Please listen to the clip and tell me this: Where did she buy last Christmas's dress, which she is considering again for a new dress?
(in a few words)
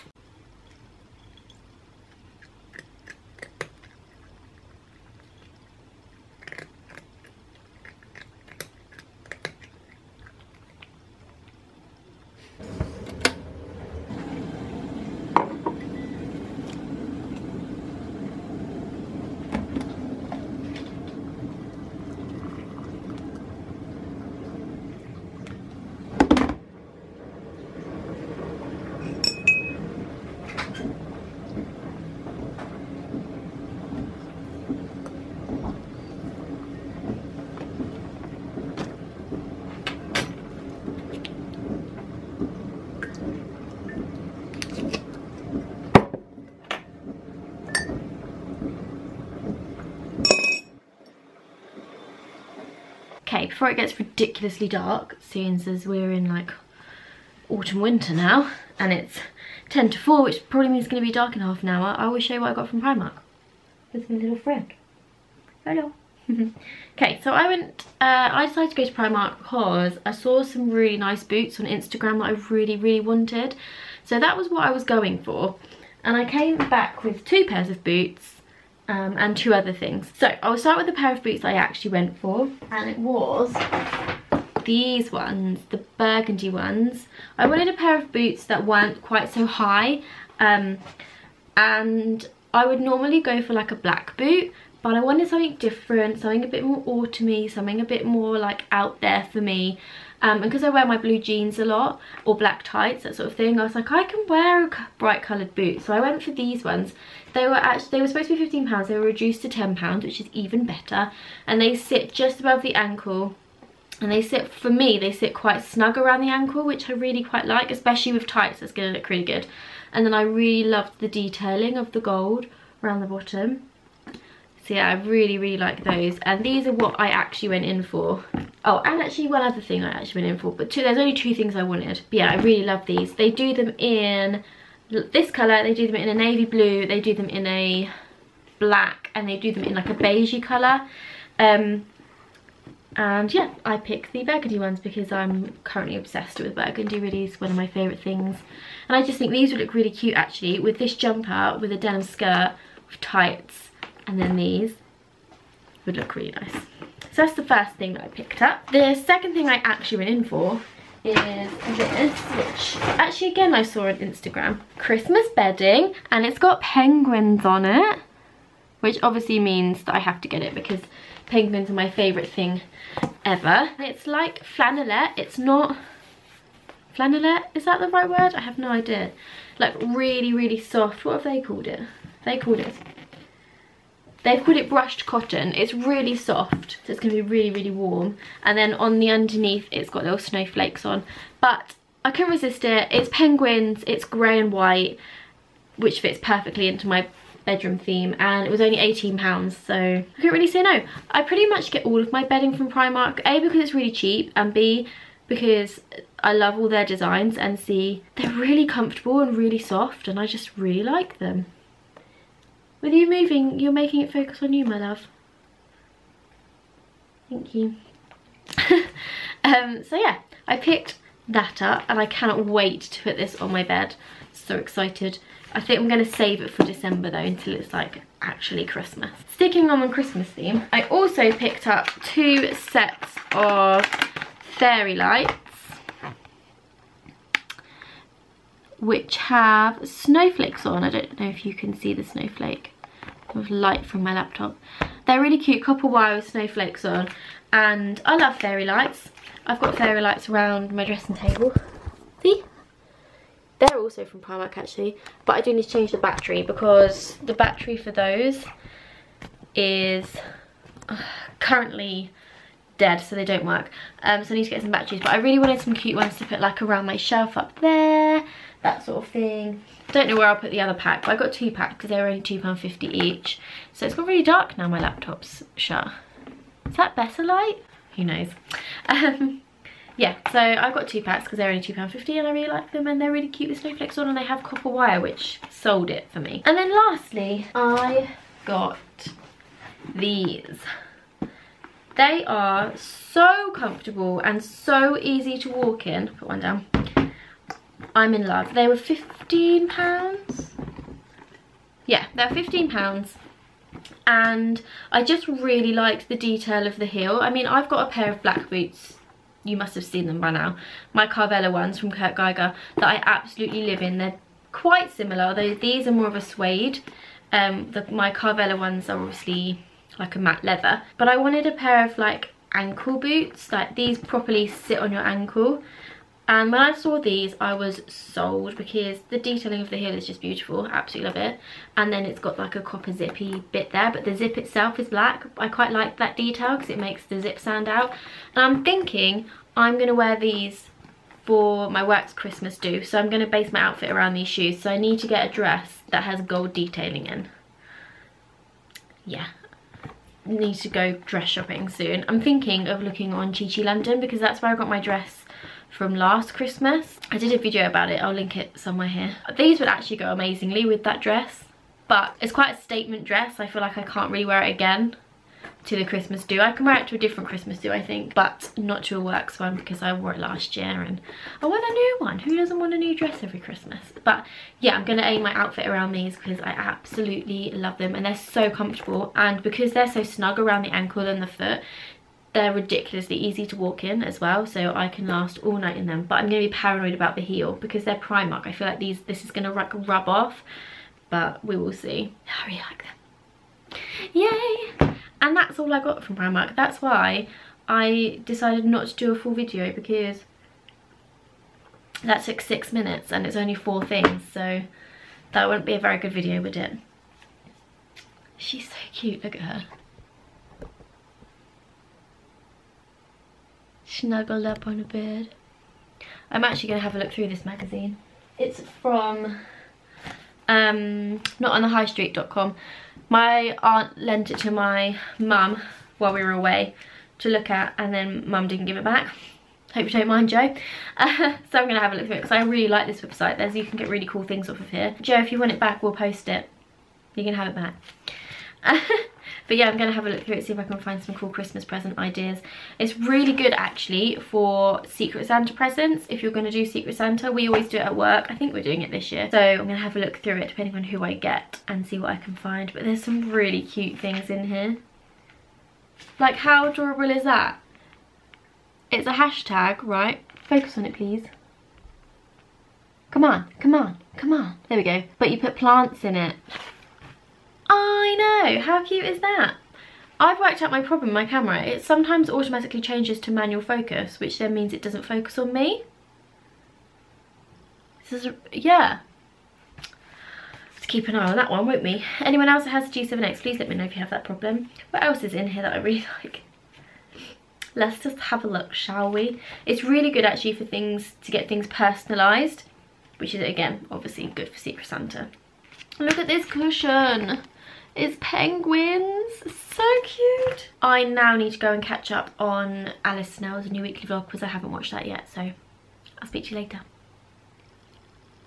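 Chi Chi London.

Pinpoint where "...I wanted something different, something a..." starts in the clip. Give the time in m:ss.
1:34.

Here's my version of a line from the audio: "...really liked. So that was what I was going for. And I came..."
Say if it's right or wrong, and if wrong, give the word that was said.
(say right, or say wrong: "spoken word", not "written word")
wrong: "wanted", not "liked".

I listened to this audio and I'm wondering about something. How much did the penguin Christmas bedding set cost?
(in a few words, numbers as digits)
£18.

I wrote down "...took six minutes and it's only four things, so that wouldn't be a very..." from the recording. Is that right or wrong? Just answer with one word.
right.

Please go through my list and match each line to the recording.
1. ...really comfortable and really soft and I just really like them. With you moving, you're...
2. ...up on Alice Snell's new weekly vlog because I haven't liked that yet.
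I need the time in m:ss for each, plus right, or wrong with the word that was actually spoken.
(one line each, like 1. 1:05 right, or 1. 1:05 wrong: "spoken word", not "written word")
1. 3:28 right
2. 8:22 wrong: "watched", not "liked".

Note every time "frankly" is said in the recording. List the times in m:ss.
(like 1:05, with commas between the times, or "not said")
not said.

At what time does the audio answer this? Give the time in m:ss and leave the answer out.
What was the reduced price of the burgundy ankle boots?
1:49.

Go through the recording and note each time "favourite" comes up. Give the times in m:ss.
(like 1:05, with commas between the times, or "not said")
2:27, 2:51.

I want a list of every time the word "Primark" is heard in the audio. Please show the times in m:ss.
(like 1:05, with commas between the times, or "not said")
1:02, 1:08, 3:22, 4:14, 6:27, 6:36.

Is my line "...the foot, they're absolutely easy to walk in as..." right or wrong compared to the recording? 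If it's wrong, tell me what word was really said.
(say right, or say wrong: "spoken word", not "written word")
wrong: "ridiculously", not "absolutely".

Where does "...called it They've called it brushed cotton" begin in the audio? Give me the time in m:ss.
3:02.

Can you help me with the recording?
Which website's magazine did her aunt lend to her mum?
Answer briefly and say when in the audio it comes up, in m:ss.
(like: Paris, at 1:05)
notonthehighstreet.com, at 7:01.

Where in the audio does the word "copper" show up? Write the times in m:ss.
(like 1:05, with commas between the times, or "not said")
4:05, 4:44, 5:32.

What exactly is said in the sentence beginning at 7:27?
We always do it at work.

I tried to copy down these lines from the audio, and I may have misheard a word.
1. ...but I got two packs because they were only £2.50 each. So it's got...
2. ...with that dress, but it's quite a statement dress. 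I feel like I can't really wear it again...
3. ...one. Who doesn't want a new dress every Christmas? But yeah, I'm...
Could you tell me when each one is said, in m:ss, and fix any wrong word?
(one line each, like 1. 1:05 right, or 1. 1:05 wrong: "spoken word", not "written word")
1. 4:31 right
2. 6:00 right
3. 6:11 right.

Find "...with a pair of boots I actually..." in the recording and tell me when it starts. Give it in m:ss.
1:20.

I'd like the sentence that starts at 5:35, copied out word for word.
I quite like that detail because it makes the zip stand out.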